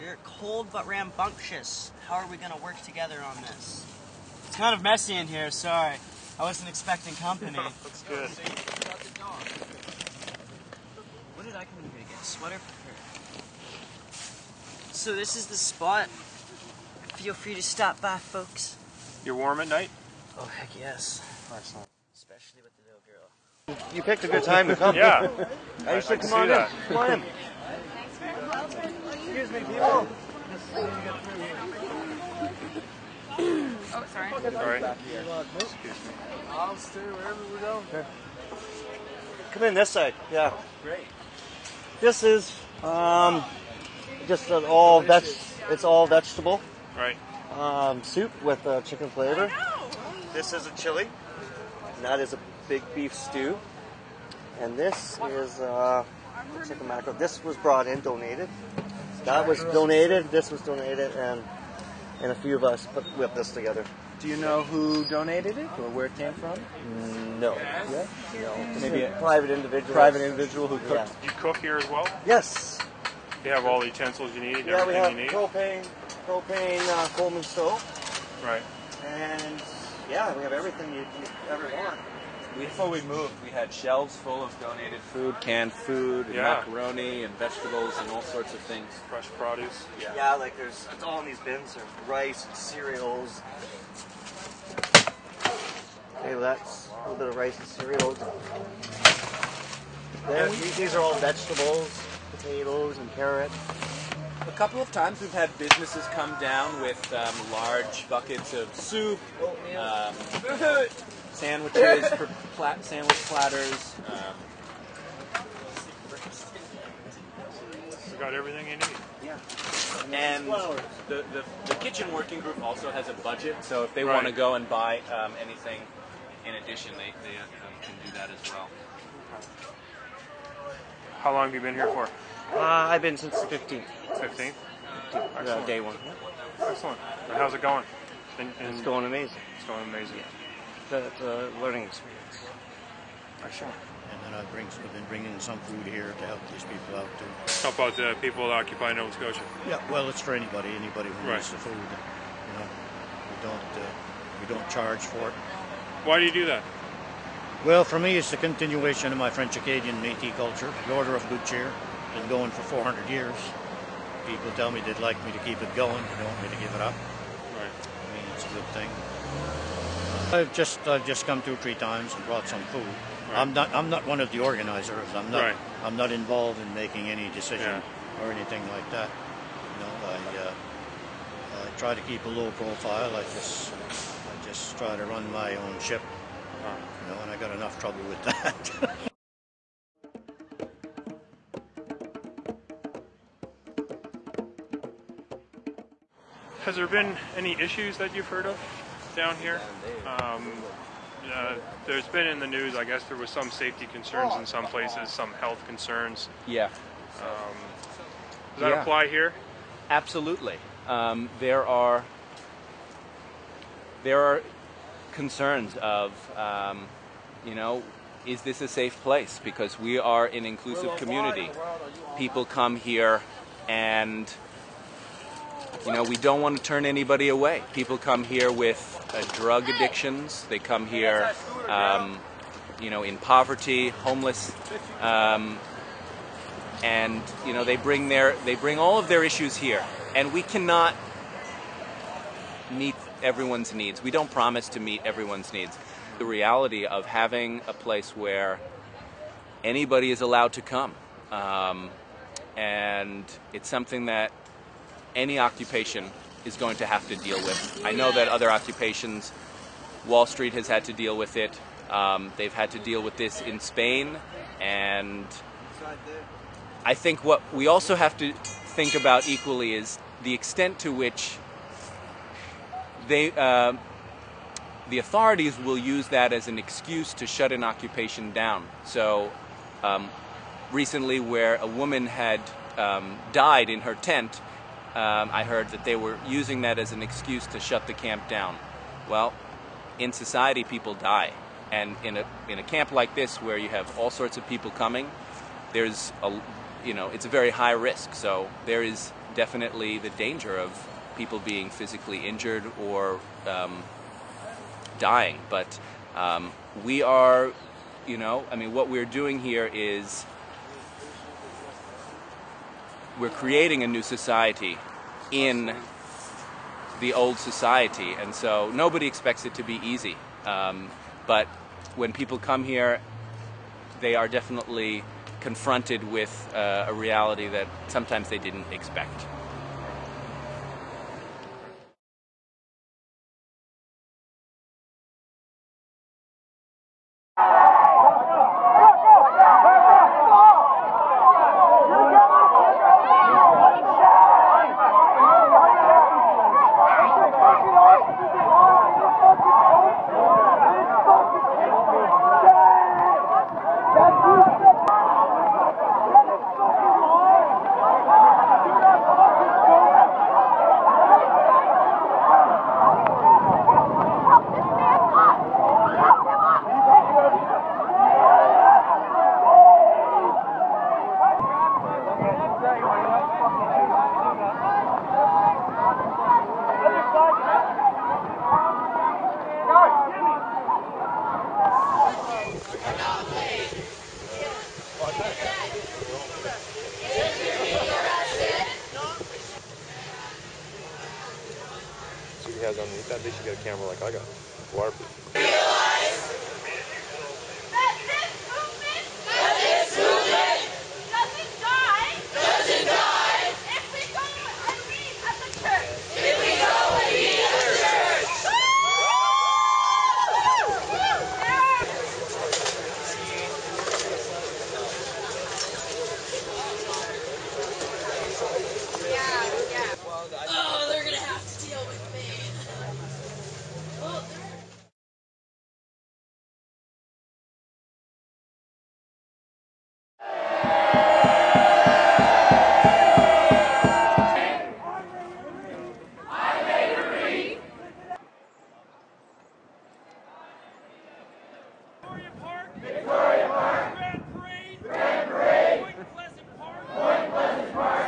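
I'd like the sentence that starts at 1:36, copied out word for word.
Okay, let that's a little bit of rice and cereals.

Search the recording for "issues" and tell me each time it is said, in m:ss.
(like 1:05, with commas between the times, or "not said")
3:17, 3:59.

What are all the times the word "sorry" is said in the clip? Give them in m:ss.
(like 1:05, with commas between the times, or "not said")
0:05, 0:34.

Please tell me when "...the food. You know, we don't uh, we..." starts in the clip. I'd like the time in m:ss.
2:31.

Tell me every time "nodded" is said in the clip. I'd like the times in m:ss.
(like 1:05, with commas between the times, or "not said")
not said.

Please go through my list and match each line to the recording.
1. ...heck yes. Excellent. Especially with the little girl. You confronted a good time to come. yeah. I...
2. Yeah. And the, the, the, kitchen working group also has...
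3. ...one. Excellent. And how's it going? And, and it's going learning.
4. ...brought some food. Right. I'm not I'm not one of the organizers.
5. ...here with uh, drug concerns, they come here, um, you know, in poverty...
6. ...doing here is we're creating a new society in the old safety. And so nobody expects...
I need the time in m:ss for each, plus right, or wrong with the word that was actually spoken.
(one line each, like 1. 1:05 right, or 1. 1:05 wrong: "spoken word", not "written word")
1. 0:20 wrong: "picked", not "confronted"
2. 1:59 right
3. 2:15 wrong: "amazing", not "learning"
4. 2:52 right
5. 3:48 wrong: "addictions", not "concerns"
6. 5:09 wrong: "society", not "safety".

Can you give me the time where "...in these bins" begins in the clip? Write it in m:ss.
1:31.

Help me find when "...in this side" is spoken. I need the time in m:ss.
0:39.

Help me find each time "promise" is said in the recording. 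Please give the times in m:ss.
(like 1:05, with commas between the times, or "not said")
4:04.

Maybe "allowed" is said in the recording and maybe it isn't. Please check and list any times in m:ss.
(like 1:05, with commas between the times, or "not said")
4:10.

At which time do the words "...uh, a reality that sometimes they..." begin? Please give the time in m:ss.
5:26.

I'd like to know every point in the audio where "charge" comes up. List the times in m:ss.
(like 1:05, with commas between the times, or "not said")
2:34.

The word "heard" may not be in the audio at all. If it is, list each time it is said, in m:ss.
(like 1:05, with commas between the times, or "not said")
3:18, 4:45.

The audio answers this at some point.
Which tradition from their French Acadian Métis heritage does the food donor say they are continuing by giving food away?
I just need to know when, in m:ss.
2:40.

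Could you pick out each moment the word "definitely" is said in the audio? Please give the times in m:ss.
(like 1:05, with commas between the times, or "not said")
4:59, 5:24.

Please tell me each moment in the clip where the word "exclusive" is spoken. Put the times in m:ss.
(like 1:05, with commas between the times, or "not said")
not said.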